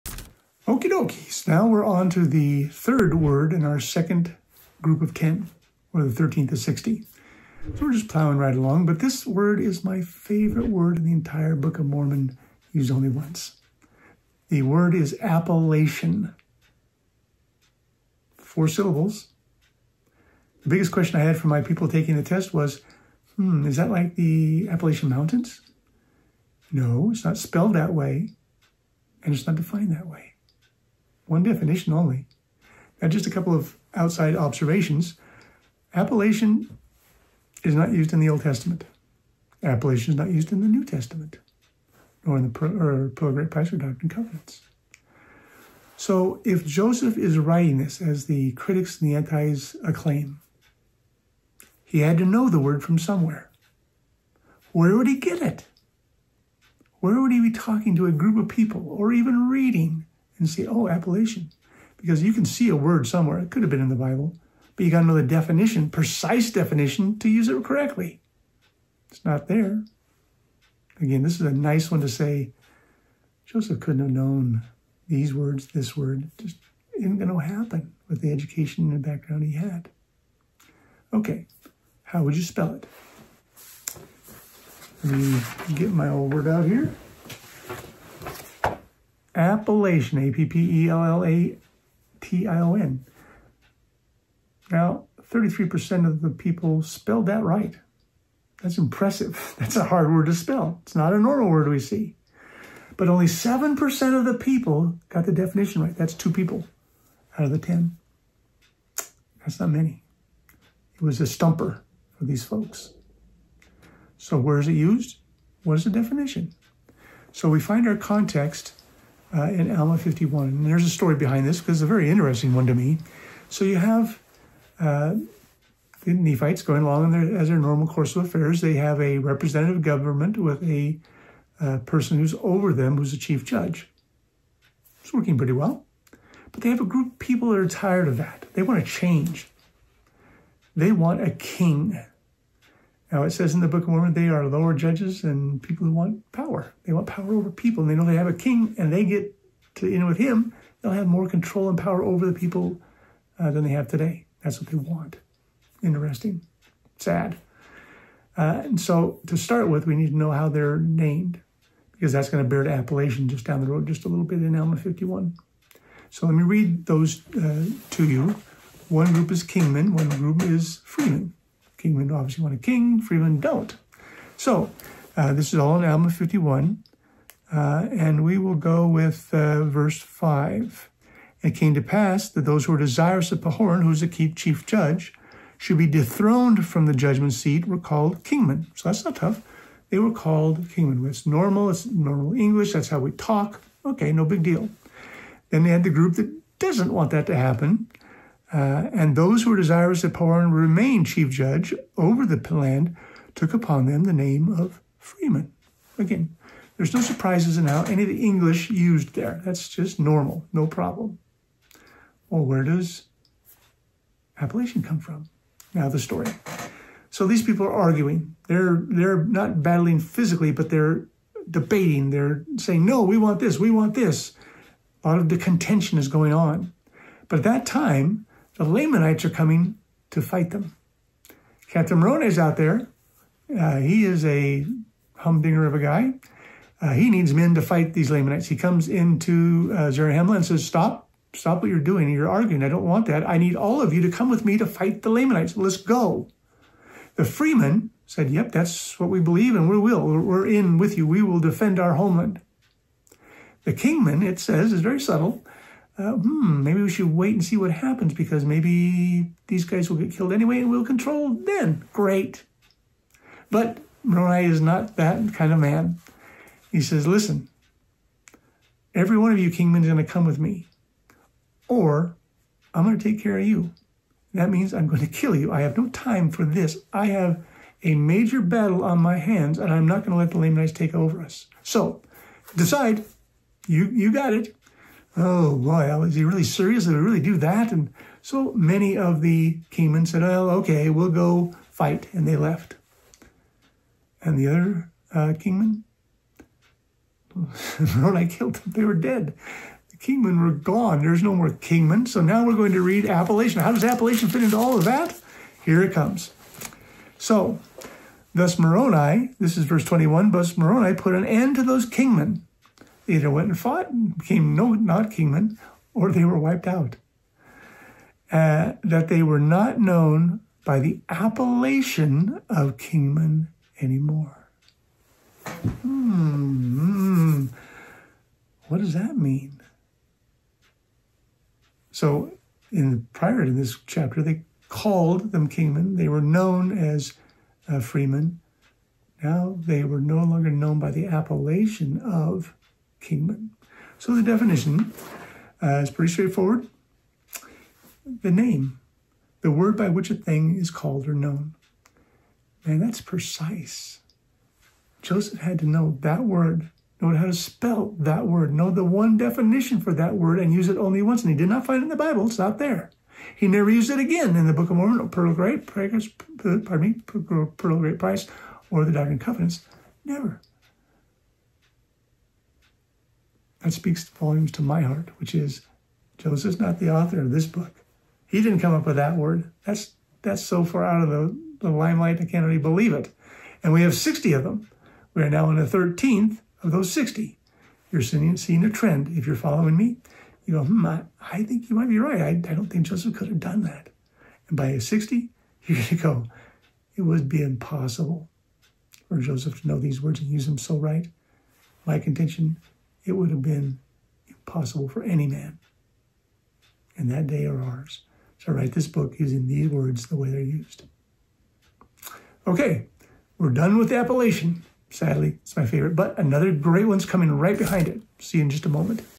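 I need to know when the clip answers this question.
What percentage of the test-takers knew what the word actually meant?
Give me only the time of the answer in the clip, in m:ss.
1:43.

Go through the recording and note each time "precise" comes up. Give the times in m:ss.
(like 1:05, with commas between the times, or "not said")
1:05, 5:53.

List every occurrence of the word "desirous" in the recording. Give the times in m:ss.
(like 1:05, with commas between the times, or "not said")
3:02, 3:19.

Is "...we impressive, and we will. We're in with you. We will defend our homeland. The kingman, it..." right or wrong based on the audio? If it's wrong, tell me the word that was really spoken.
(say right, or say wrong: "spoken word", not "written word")
wrong: "believe", not "impressive".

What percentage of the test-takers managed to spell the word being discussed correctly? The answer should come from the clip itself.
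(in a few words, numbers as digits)
33%.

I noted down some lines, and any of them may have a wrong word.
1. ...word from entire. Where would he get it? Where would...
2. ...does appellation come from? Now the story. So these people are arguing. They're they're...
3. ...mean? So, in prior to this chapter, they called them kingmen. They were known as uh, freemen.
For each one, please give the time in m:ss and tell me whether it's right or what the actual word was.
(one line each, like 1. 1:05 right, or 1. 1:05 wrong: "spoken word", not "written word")
1. 0:52 wrong: "somewhere", not "entire"
2. 3:32 right
3. 5:29 right.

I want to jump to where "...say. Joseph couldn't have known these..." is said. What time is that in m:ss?
1:12.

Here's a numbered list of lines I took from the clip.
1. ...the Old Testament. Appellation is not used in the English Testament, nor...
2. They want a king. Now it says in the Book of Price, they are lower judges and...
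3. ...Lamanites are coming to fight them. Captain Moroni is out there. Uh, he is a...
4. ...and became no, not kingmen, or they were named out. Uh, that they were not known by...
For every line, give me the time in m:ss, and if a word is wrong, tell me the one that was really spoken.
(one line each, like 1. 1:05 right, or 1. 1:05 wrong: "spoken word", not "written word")
1. 0:38 wrong: "New", not "English"
2. 2:20 wrong: "Mormon", not "Price"
3. 3:48 right
4. 5:13 wrong: "wiped", not "named".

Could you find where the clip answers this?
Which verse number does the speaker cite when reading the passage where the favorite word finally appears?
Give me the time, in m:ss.
5:09.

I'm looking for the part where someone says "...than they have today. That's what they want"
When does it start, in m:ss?
2:33.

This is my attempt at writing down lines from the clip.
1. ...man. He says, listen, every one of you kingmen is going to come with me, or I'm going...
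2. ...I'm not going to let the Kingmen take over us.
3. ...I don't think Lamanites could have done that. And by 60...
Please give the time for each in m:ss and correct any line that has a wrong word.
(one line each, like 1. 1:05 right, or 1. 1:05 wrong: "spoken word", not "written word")
1. 4:25 right
2. 4:39 wrong: "Lamanites", not "Kingmen"
3. 6:32 wrong: "Joseph", not "Lamanites".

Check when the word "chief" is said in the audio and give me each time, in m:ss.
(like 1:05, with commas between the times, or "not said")
2:13, 3:04, 3:21.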